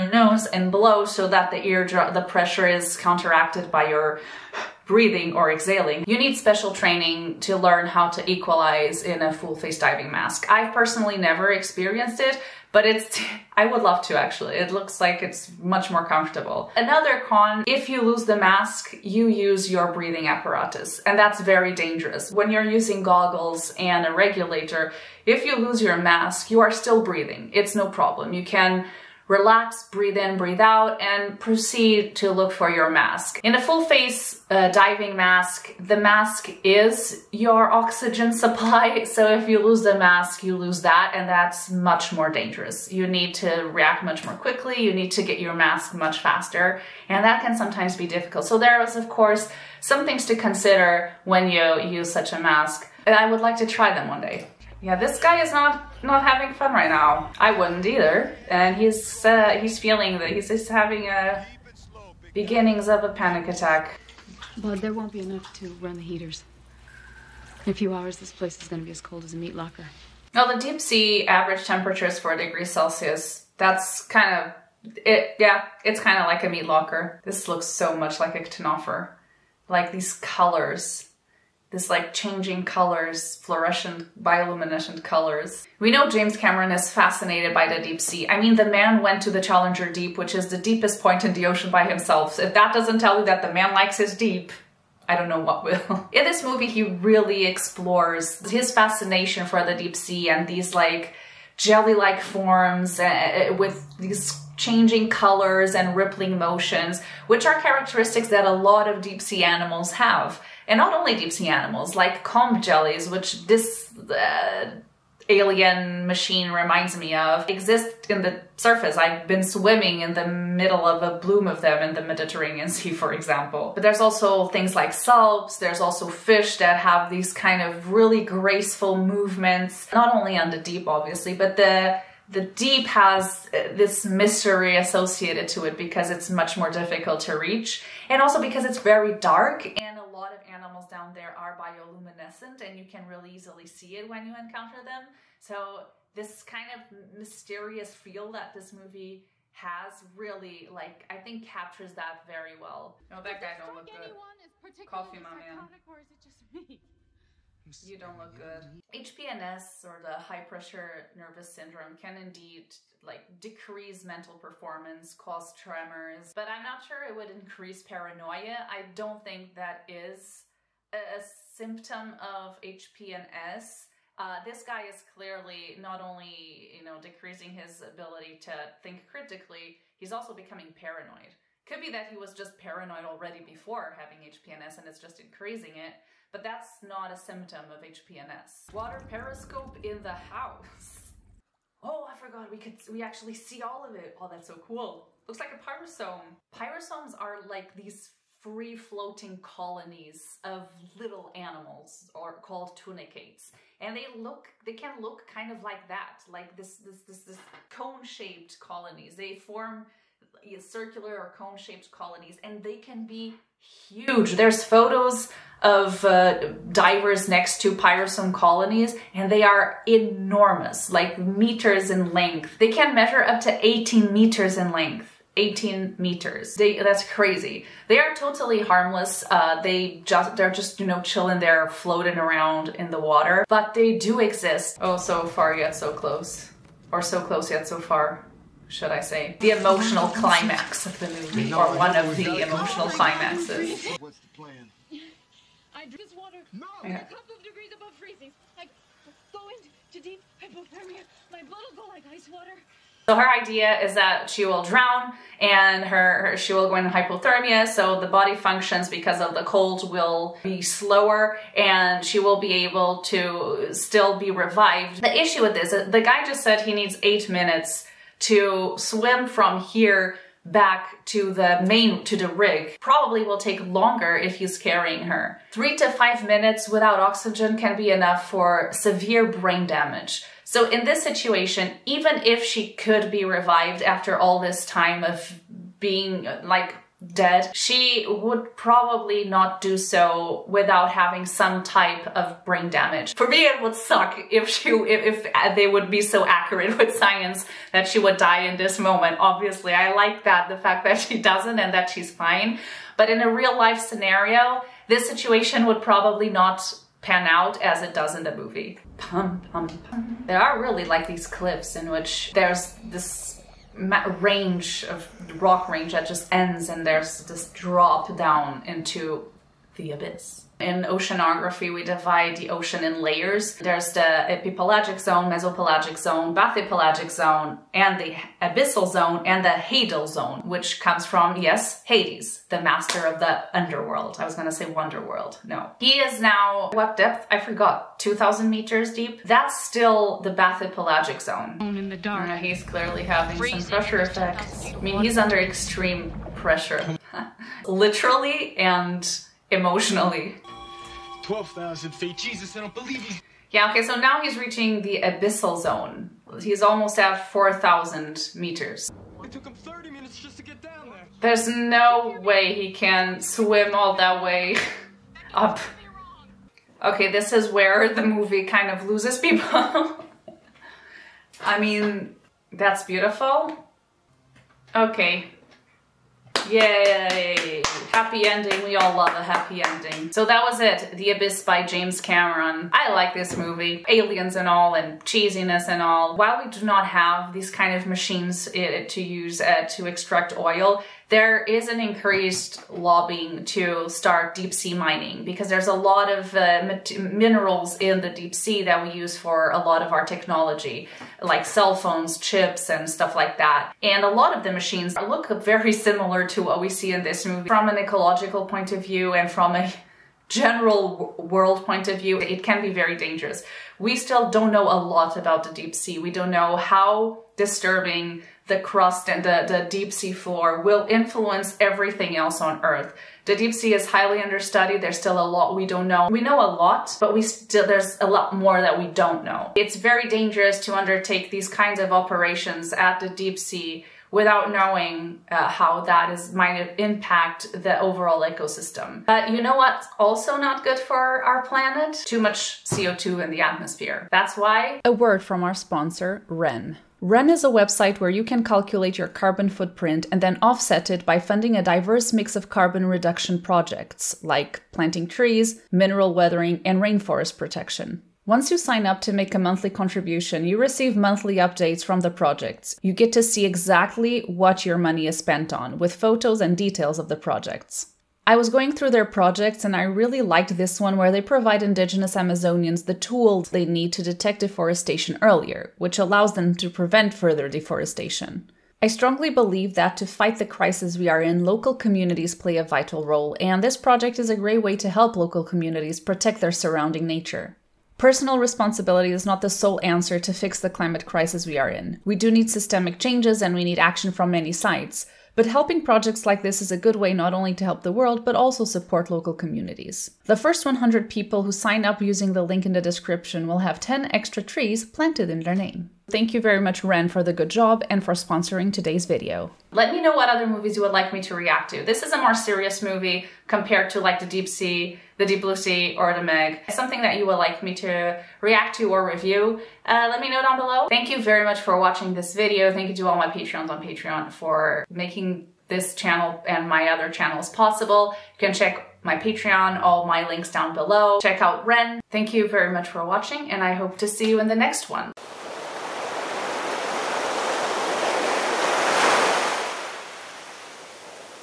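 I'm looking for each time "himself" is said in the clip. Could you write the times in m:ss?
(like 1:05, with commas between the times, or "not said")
1:31.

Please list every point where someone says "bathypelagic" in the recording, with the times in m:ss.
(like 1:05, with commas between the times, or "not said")
5:26, 5:40.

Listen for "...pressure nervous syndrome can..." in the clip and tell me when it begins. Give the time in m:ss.
2:40.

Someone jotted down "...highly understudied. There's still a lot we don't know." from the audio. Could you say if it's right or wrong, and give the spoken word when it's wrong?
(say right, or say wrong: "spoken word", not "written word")
right.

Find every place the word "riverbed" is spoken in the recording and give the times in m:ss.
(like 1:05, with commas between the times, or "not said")
not said.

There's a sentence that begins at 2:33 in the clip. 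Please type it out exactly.
No, that guy don't look good.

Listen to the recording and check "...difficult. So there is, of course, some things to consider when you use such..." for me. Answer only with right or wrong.
right.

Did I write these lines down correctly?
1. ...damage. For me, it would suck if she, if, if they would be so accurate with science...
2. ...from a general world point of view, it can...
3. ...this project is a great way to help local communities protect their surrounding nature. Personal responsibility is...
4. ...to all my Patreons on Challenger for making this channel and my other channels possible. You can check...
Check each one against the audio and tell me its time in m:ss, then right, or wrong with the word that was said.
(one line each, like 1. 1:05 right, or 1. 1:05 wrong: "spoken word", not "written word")
1. 4:52 right
2. 6:49 right
3. 8:03 right
4. 8:42 wrong: "Patreon", not "Challenger".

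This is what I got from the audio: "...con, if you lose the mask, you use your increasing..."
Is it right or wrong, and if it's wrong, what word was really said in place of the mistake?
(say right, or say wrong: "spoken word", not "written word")
wrong: "breathing", not "increasing".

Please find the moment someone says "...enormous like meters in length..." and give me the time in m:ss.
3:39.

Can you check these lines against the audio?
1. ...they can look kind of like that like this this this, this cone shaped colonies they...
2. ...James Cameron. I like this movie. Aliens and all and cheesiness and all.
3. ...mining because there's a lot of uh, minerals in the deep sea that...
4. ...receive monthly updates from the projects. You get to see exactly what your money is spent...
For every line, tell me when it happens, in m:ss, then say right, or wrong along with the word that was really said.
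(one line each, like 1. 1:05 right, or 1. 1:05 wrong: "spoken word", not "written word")
1. 3:24 right
2. 6:21 right
3. 6:34 right
4. 7:40 right.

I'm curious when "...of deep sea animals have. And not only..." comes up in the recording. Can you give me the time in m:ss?
1:48.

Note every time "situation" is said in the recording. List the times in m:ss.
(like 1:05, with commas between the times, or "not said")
4:41, 5:05.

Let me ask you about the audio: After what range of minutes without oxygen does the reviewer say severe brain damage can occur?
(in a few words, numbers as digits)
3 to 5.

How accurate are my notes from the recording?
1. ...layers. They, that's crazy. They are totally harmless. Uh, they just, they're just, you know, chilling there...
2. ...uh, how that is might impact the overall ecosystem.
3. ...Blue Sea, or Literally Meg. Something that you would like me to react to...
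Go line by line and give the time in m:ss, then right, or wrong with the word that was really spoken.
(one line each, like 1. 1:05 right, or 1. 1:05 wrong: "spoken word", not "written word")
1. 3:45 wrong: "meters", not "layers"
2. 7:15 right
3. 8:35 wrong: "The", not "Literally".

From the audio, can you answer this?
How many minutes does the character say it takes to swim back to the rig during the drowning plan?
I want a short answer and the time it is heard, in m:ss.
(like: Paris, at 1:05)
8, at 4:27.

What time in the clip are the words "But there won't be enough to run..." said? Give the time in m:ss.
1:04.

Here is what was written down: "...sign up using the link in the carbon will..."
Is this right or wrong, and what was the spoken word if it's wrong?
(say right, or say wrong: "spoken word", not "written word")
wrong: "description", not "carbon".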